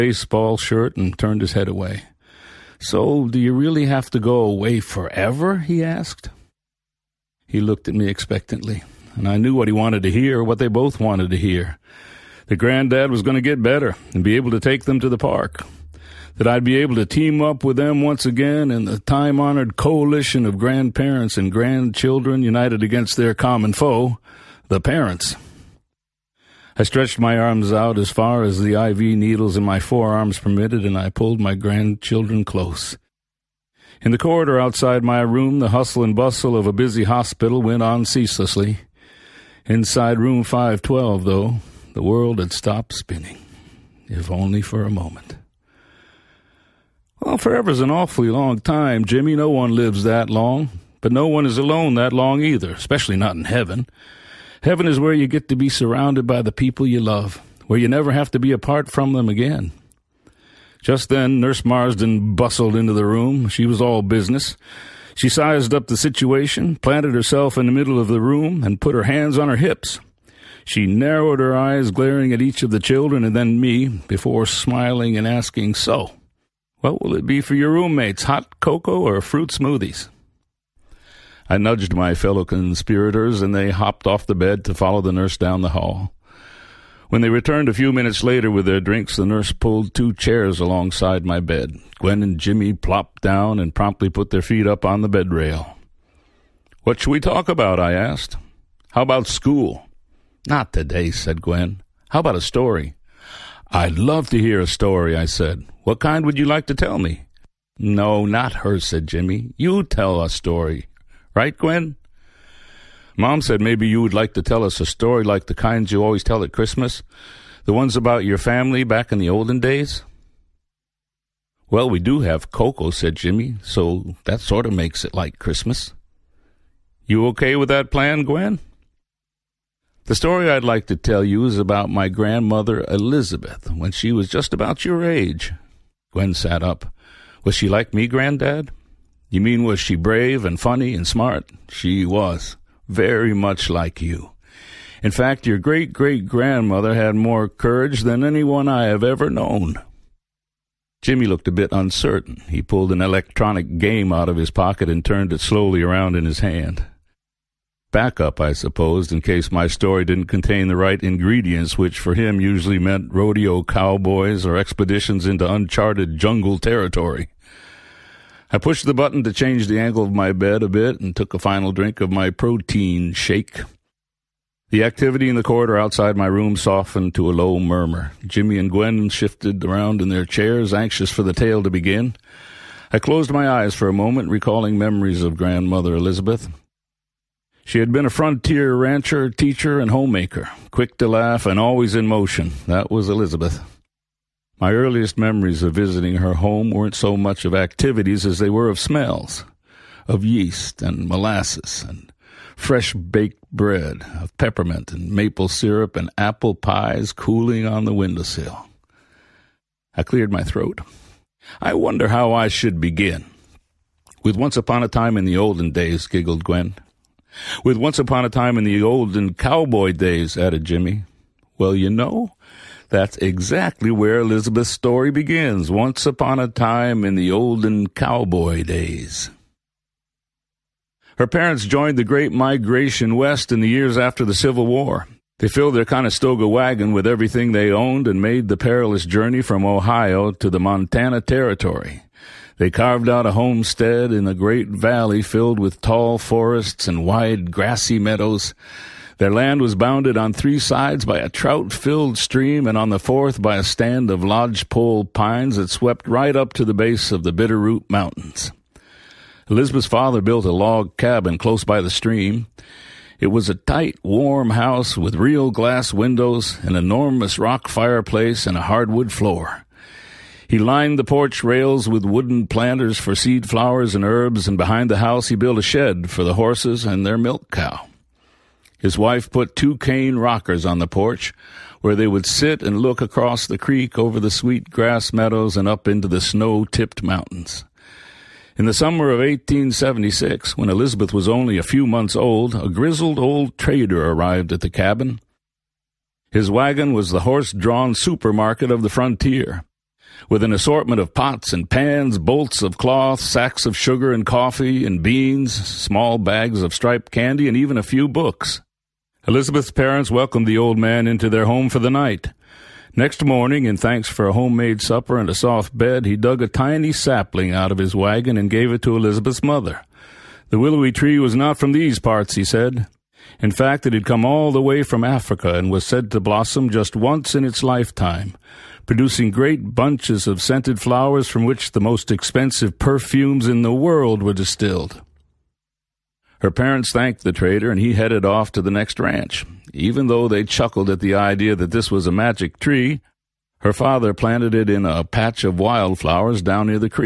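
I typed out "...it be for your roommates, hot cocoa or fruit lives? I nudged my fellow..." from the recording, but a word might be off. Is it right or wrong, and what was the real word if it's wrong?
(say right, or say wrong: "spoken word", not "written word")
wrong: "smoothies", not "lives".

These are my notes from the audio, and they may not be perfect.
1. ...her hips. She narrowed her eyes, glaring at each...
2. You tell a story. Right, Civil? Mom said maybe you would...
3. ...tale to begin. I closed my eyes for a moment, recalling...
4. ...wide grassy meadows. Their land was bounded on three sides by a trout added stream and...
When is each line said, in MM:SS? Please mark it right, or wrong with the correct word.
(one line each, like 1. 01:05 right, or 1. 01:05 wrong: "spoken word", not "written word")
1. 01:09 right
2. 01:49 wrong: "Gwen", not "Civil"
3. 03:01 right
4. 04:07 wrong: "filled", not "added".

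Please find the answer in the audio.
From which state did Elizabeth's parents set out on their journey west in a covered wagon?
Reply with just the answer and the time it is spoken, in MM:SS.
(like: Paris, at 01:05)
Ohio, at 03:59.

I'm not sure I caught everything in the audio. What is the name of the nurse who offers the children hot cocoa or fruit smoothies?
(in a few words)
Nurse Marsden.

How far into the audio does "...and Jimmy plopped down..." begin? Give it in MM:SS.
01:32.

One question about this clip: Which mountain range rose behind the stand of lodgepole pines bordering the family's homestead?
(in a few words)
Bitterroot Mountains.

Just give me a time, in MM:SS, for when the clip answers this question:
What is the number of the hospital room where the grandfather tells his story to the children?
00:40.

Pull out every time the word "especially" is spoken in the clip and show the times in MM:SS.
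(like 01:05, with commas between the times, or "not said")
00:52.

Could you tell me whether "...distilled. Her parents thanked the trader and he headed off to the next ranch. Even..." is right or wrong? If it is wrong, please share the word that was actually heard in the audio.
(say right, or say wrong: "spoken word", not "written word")
right.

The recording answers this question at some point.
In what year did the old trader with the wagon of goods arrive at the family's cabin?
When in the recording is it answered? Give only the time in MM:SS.
04:49.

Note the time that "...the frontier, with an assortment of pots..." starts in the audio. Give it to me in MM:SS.
04:58.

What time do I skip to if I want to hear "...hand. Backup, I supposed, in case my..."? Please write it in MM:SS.
02:36.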